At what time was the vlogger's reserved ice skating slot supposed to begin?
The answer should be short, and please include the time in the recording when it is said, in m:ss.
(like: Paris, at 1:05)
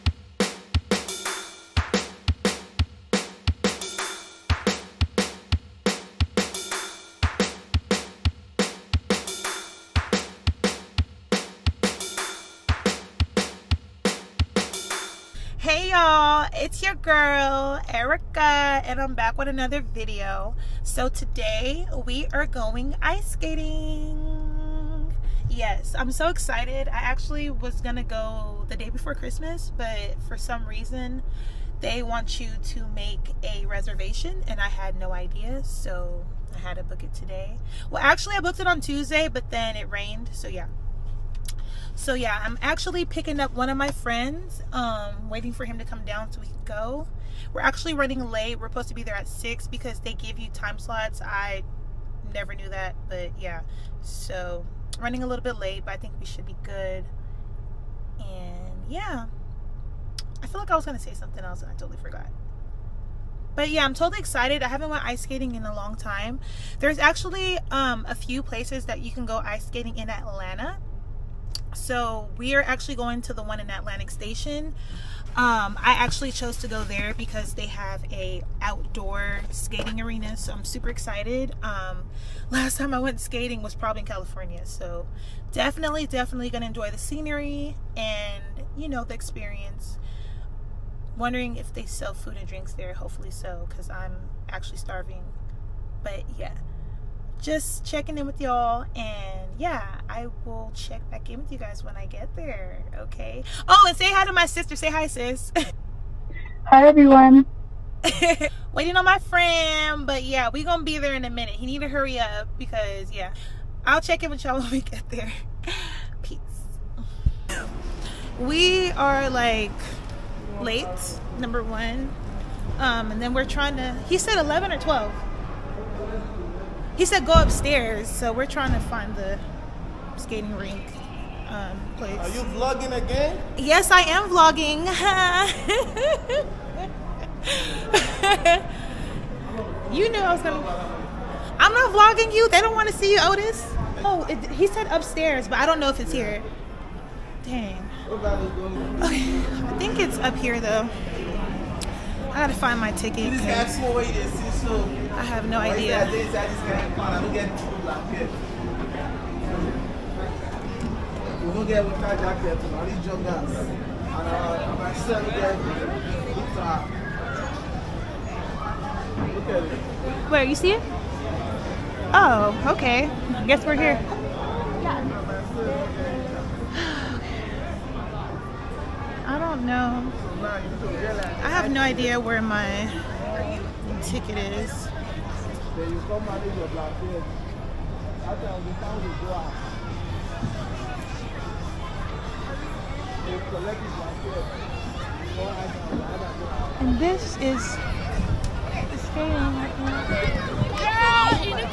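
6, at 0:49.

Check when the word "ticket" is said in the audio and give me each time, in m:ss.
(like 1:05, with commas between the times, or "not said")
2:32, 3:04.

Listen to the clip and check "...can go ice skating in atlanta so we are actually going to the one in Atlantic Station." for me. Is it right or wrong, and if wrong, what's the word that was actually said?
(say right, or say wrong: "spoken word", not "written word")
right.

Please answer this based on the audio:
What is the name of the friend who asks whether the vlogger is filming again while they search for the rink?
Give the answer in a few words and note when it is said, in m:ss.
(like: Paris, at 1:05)
Otis, at 2:23.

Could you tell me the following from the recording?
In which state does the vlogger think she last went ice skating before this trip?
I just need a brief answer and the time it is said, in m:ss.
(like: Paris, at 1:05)
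California, at 1:24.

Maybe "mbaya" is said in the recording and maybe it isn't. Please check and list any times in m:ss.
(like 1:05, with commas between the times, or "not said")
not said.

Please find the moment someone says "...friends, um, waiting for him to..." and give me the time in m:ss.
0:43.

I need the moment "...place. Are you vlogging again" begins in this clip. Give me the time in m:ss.
2:11.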